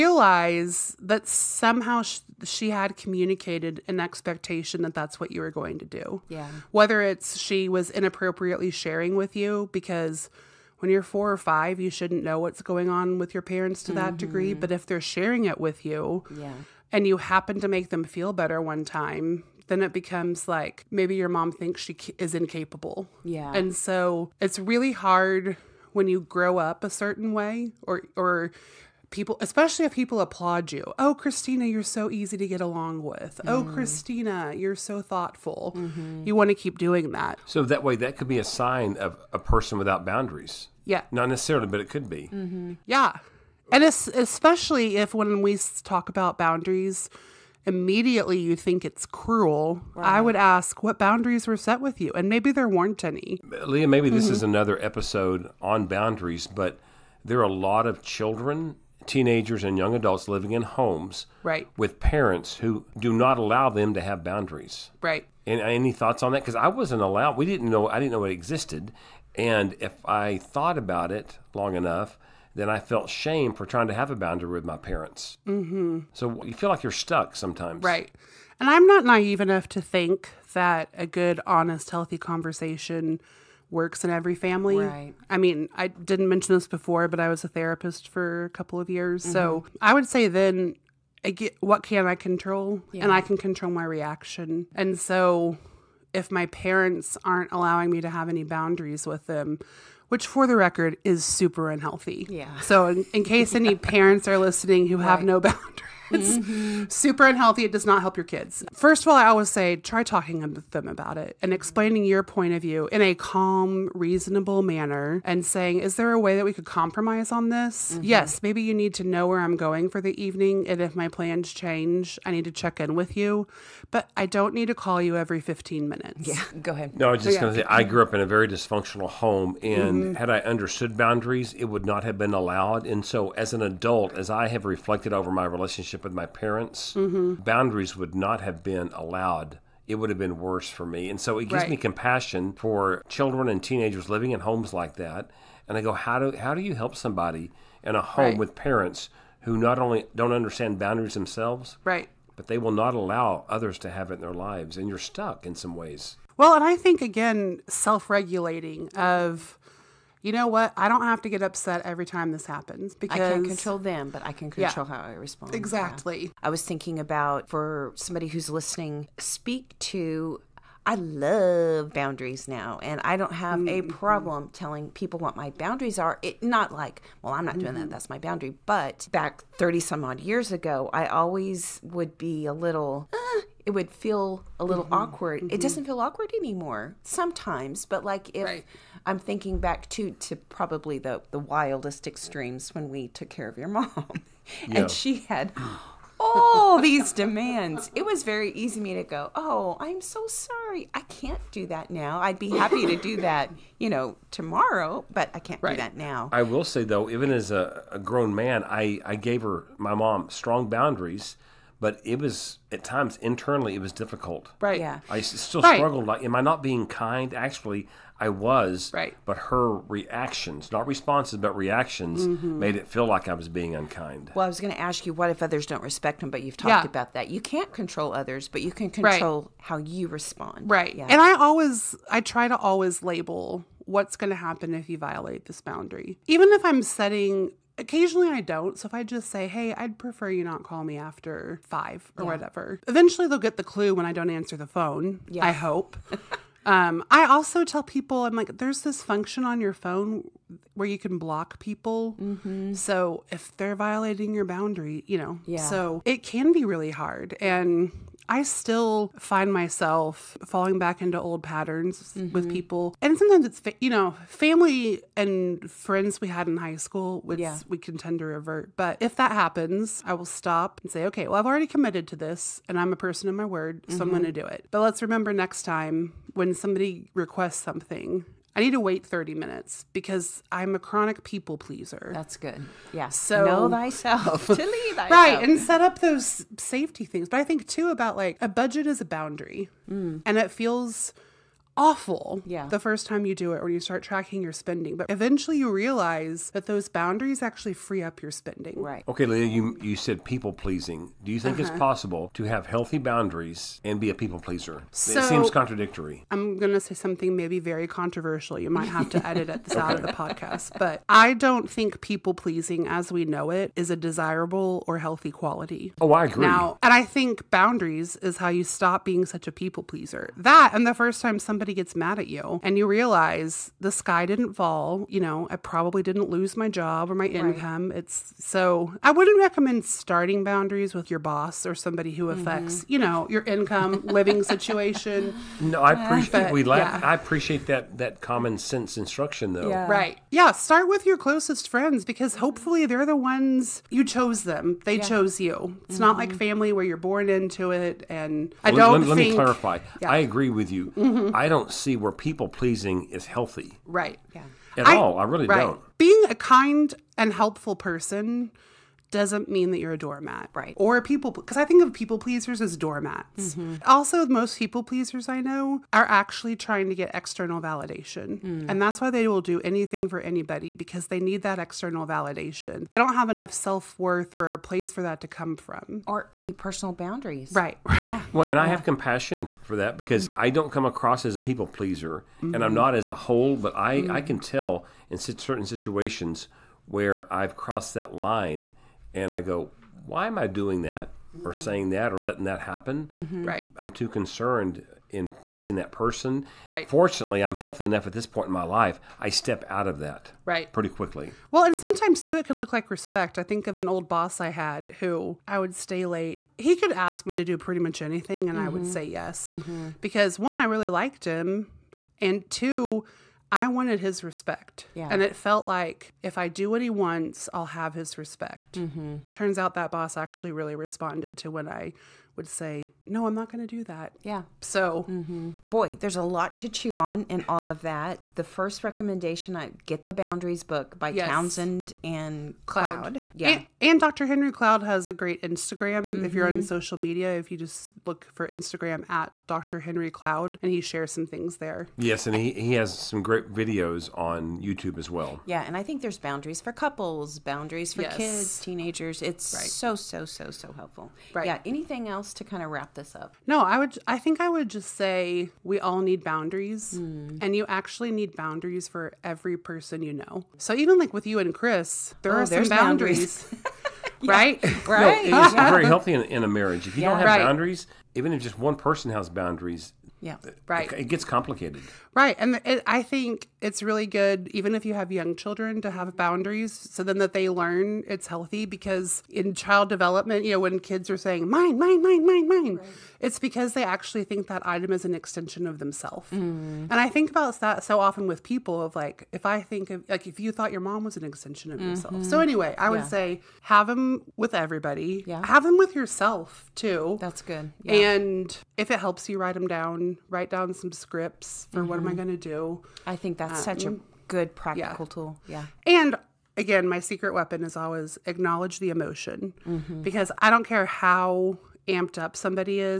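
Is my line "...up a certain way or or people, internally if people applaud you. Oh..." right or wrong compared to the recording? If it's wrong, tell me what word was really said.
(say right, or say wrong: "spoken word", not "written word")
wrong: "especially", not "internally".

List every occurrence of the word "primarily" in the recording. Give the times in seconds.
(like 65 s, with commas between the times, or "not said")
not said.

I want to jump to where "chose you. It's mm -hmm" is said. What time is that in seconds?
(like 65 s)
345 s.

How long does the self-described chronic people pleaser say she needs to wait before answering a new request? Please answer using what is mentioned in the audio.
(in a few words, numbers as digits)
30 minutes.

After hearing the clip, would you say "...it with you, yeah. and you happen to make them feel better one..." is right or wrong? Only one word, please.
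right.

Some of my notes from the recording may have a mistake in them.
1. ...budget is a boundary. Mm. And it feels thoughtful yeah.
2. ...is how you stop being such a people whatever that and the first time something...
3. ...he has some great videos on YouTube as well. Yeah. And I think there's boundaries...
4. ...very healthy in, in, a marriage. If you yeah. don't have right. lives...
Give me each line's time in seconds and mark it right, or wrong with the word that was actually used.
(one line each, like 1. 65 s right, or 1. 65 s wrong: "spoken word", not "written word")
1. 288 s wrong: "awful", not "thoughtful"
2. 318 s wrong: "pleaser", not "whatever"
3. 442 s right
4. 465 s wrong: "boundaries", not "lives".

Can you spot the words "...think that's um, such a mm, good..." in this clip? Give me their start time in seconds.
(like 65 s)
503 s.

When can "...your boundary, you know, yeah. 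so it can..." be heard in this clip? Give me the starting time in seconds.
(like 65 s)
254 s.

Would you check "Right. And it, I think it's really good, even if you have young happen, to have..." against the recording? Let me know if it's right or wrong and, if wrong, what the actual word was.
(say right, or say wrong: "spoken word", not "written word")
wrong: "children", not "happen".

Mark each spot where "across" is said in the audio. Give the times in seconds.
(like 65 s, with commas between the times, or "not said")
380 s.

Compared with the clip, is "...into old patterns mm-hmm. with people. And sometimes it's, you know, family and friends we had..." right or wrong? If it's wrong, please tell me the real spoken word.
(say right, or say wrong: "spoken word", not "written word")
right.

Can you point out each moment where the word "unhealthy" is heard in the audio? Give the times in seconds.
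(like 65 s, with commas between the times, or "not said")
101 s, 107 s.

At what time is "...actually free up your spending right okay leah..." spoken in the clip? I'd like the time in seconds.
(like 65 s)
297 s.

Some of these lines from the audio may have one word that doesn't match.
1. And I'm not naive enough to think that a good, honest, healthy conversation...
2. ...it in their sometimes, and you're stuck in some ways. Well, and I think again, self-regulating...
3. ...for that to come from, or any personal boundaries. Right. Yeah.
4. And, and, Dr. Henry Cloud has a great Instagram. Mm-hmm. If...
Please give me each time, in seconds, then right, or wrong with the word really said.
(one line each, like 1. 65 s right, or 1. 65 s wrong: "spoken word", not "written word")
1. 78 s right
2. 154 s wrong: "lives", not "sometimes"
3. 374 s right
4. 433 s right.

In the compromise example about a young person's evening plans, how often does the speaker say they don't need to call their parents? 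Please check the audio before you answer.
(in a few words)
every 15 minutes.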